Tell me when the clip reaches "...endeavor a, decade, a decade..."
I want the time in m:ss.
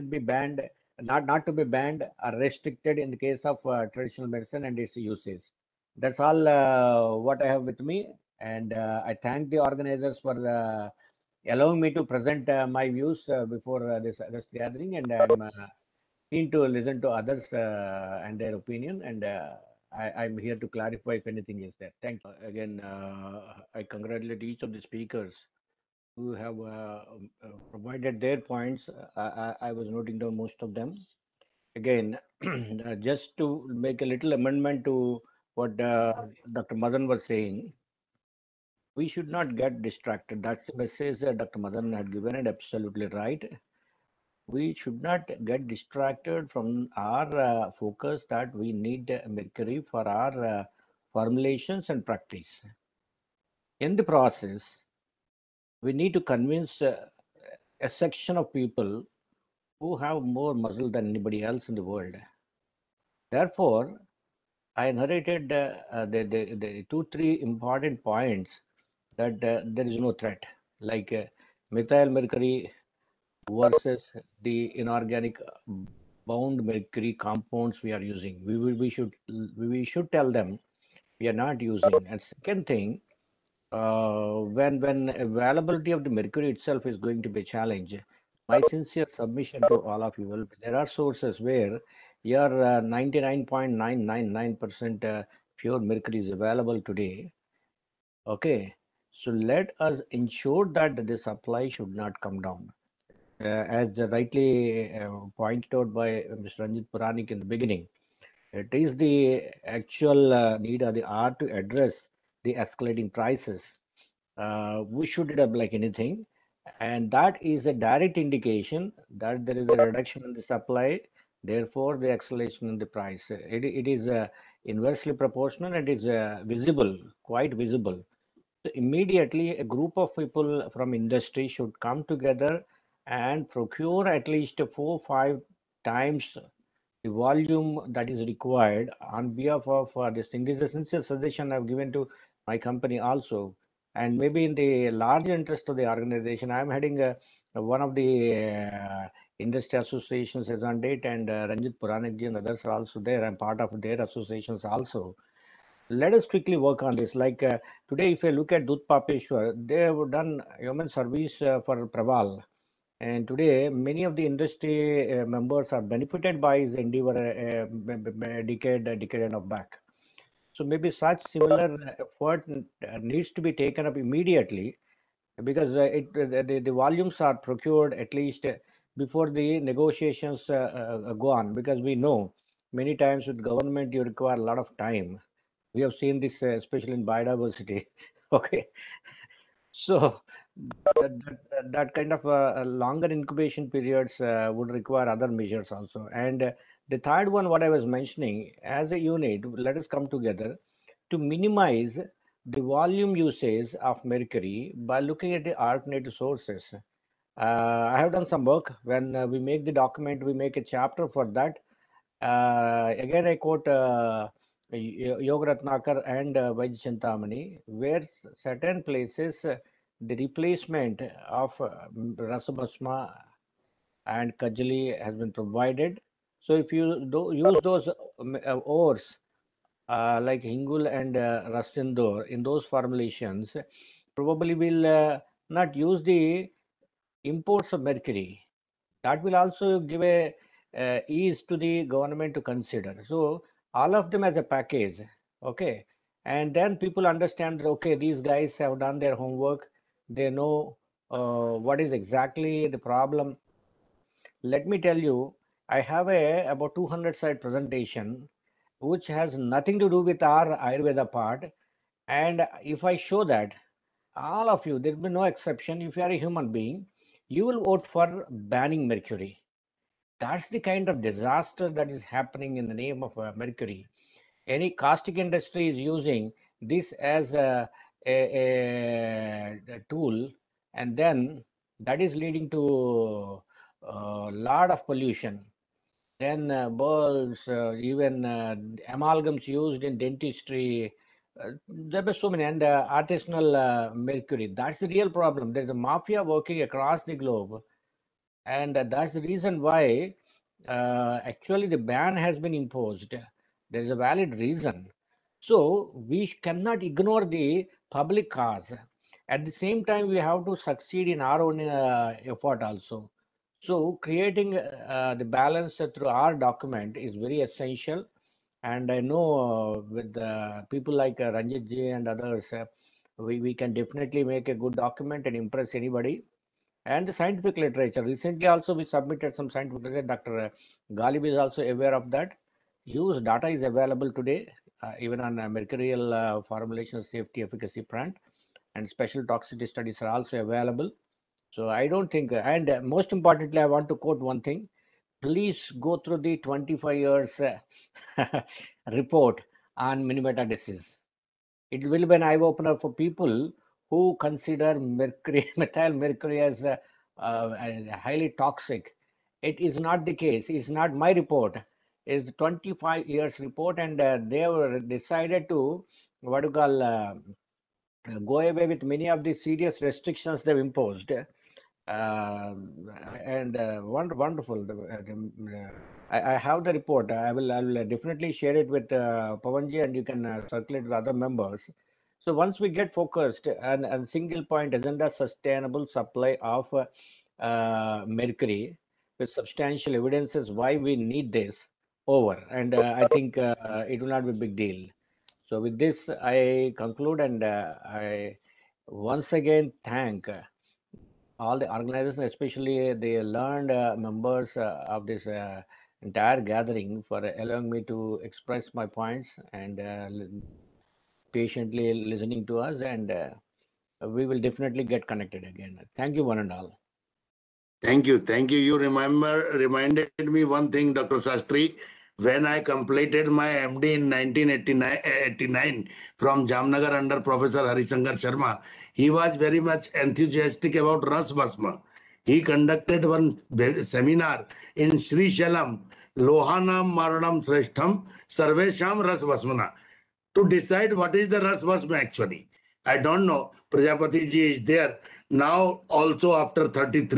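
2:46.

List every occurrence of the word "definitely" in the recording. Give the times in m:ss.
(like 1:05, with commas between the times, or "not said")
5:23, 6:17, 6:54.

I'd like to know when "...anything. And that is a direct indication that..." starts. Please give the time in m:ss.
1:55.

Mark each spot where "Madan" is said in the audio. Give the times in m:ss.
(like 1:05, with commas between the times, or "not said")
0:36, 0:41.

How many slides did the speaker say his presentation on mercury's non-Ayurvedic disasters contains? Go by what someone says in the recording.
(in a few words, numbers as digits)
200.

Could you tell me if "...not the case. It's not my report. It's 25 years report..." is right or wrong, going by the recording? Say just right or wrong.
right.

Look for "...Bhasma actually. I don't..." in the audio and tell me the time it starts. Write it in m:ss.
7:21.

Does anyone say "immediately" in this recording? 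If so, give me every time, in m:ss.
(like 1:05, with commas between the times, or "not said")
2:08, 2:53.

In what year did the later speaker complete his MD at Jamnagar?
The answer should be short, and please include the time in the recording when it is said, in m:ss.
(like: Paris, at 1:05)
1989, at 7:04.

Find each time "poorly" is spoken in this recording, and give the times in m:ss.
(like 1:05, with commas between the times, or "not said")
not said.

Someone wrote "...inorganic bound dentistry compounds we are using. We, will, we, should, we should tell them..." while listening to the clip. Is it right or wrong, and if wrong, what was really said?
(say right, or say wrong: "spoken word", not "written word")
wrong: "mercury", not "dentistry".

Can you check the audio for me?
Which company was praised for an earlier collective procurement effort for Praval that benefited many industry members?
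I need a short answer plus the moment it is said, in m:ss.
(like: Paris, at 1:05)
Dhootapapeshwar, at 2:38.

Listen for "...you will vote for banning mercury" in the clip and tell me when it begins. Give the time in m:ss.
4:27.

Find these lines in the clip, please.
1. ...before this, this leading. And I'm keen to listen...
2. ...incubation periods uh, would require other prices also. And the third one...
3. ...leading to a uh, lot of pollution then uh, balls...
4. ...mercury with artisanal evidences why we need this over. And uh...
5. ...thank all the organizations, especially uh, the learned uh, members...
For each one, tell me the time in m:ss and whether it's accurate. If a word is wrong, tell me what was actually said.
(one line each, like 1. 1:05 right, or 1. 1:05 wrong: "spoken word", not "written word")
1. 0:13 wrong: "gathering", not "leading"
2. 3:13 wrong: "measures", not "prices"
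3. 4:42 right
4. 6:28 wrong: "substantial", not "artisanal"
5. 6:39 right.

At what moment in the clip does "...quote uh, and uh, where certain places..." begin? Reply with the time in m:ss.
3:33.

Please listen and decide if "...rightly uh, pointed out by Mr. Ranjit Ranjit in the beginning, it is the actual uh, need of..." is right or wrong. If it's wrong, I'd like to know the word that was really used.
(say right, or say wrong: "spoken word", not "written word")
wrong: "Puranik", not "Ranjit".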